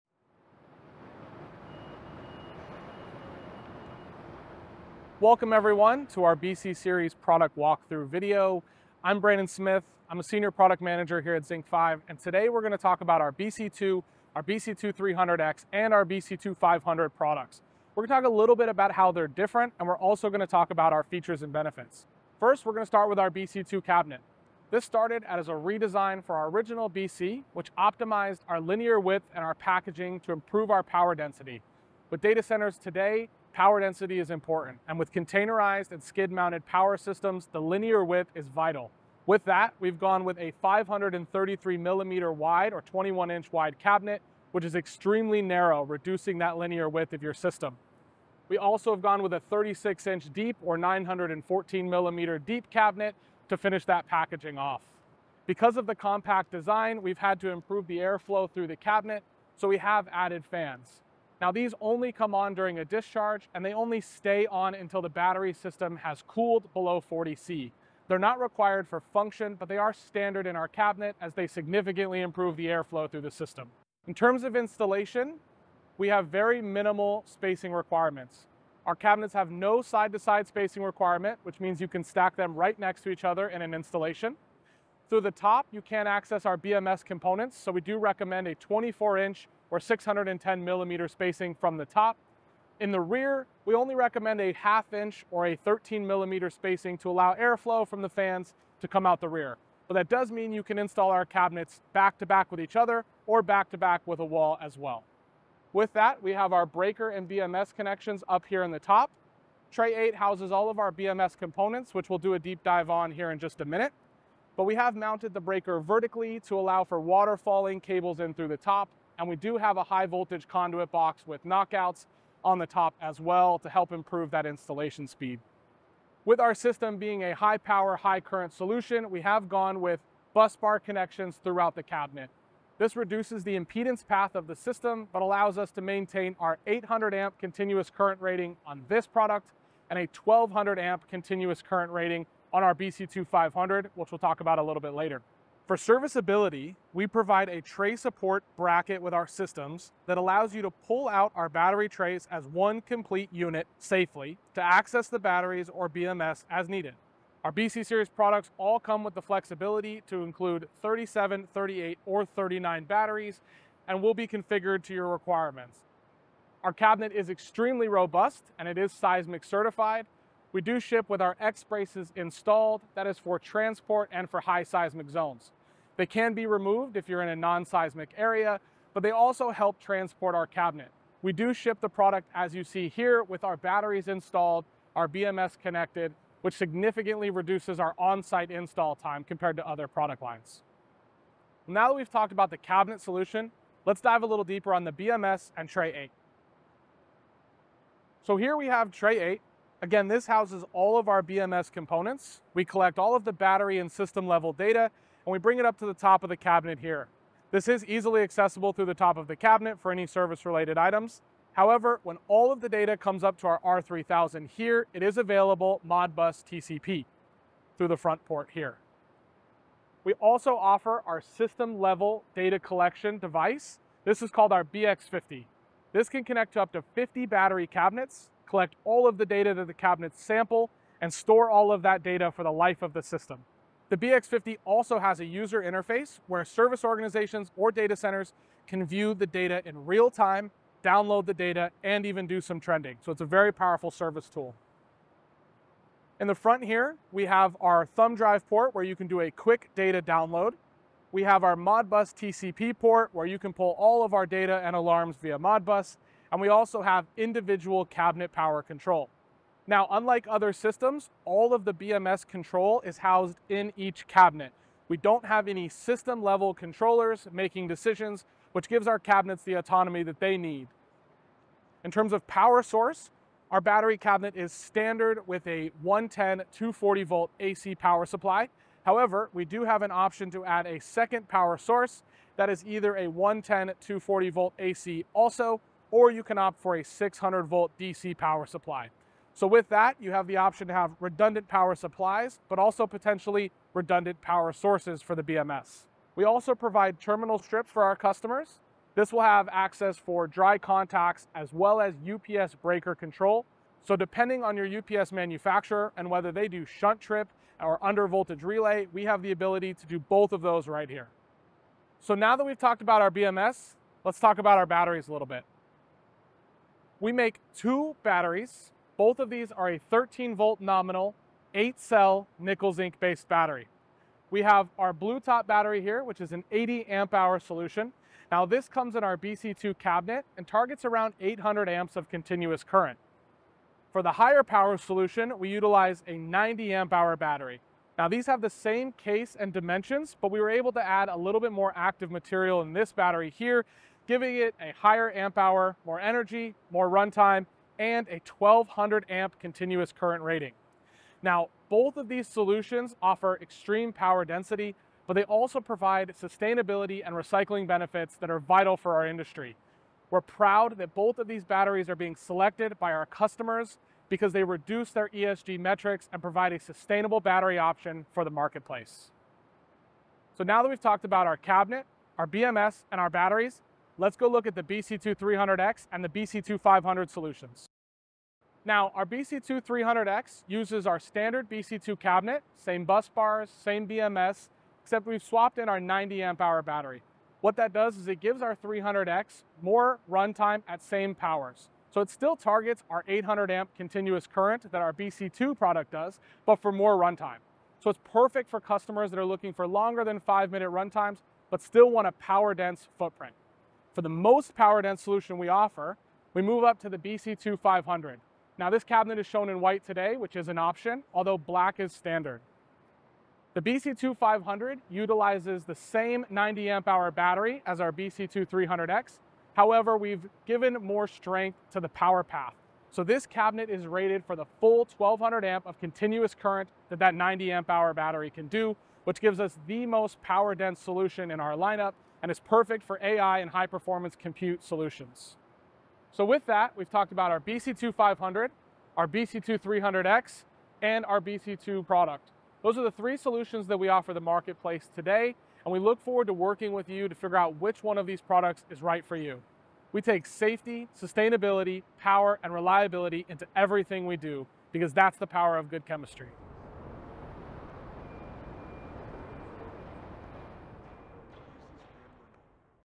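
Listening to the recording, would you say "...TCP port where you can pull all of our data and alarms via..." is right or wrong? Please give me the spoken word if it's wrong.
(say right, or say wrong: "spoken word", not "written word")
right.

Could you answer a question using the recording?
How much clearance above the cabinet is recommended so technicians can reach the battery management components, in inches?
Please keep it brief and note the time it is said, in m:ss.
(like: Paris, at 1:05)
24 inches, at 1:28.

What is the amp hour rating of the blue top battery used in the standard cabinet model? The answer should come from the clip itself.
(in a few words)
80 amp hour.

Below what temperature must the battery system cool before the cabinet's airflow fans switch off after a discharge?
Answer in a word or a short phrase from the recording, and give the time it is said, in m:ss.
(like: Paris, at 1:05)
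40 C, at 1:07.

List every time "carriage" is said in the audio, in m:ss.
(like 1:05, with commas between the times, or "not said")
not said.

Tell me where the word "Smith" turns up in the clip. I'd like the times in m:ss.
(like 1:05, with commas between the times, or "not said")
0:09.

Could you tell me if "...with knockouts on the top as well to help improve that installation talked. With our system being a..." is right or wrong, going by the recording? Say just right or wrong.
wrong.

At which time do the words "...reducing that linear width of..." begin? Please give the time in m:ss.
0:45.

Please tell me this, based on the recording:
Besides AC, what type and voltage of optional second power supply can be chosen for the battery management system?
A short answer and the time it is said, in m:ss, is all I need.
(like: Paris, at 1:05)
600 volt DC, at 4:46.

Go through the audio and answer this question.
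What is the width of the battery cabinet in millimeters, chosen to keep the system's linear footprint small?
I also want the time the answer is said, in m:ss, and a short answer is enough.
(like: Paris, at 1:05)
533 millimeters, at 0:40.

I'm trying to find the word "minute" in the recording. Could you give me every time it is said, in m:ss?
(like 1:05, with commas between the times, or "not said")
1:53, 6:40.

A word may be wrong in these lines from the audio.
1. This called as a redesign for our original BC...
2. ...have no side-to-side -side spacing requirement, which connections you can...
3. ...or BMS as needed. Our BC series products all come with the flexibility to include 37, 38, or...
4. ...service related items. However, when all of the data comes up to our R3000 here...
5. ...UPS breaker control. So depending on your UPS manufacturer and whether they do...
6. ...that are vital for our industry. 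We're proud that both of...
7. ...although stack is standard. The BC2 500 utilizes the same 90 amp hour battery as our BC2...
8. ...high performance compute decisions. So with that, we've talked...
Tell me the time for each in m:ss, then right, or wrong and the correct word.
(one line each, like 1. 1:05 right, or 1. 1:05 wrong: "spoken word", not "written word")
1. 0:24 wrong: "started", not "called"
2. 1:19 wrong: "means", not "connections"
3. 2:35 right
4. 3:30 right
5. 5:02 right
6. 5:58 right
7. 6:51 wrong: "black", not "stack"
8. 7:13 wrong: "solutions", not "decisions".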